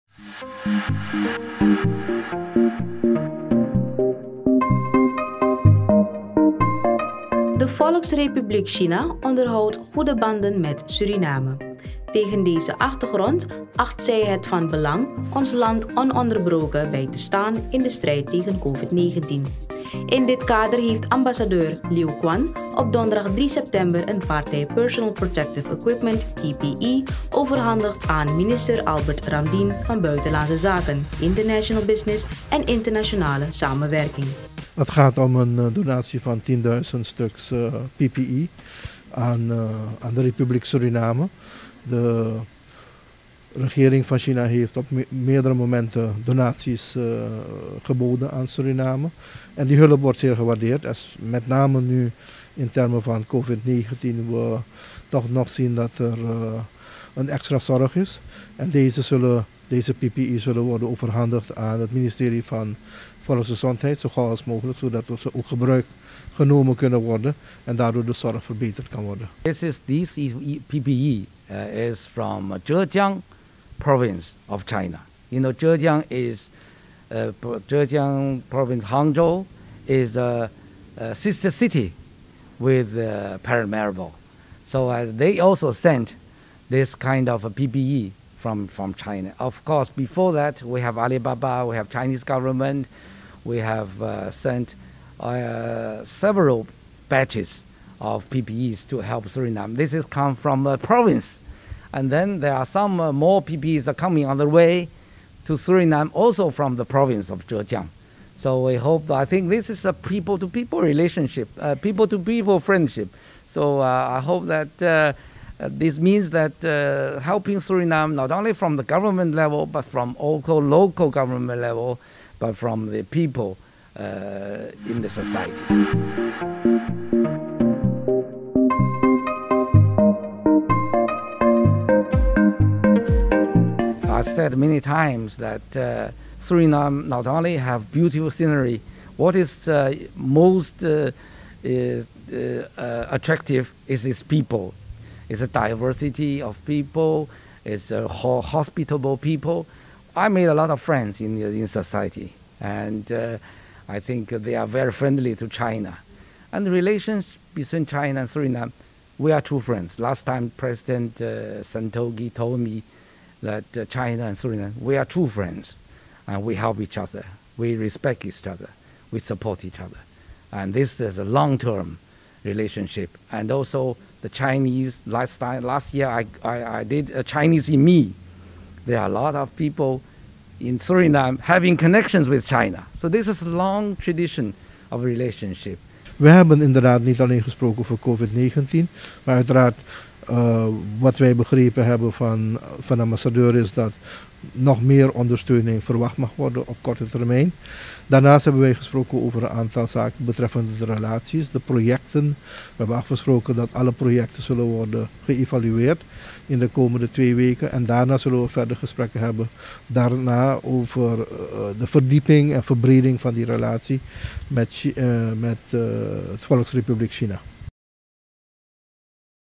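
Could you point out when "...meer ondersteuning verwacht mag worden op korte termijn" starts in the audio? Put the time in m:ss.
3:14.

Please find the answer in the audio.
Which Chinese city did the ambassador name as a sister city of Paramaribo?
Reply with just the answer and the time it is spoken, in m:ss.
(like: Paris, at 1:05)
Hangzhou, at 1:18.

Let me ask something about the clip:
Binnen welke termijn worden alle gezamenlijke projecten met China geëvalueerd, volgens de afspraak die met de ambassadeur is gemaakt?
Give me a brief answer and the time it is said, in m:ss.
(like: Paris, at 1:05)
2 weken, at 3:27.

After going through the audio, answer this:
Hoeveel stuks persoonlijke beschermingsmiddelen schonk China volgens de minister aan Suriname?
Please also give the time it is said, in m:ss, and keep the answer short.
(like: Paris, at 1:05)
10000, at 0:36.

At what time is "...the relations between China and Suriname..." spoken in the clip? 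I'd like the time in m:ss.
2:36.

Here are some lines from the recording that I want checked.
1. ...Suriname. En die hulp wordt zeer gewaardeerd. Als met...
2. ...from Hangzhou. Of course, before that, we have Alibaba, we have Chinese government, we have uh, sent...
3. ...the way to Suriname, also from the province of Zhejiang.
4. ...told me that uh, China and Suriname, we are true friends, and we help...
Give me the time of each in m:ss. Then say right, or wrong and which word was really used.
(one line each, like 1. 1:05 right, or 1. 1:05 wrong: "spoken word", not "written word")
1. 0:48 right
2. 1:28 wrong: "China", not "Hangzhou"
3. 1:44 right
4. 2:42 right.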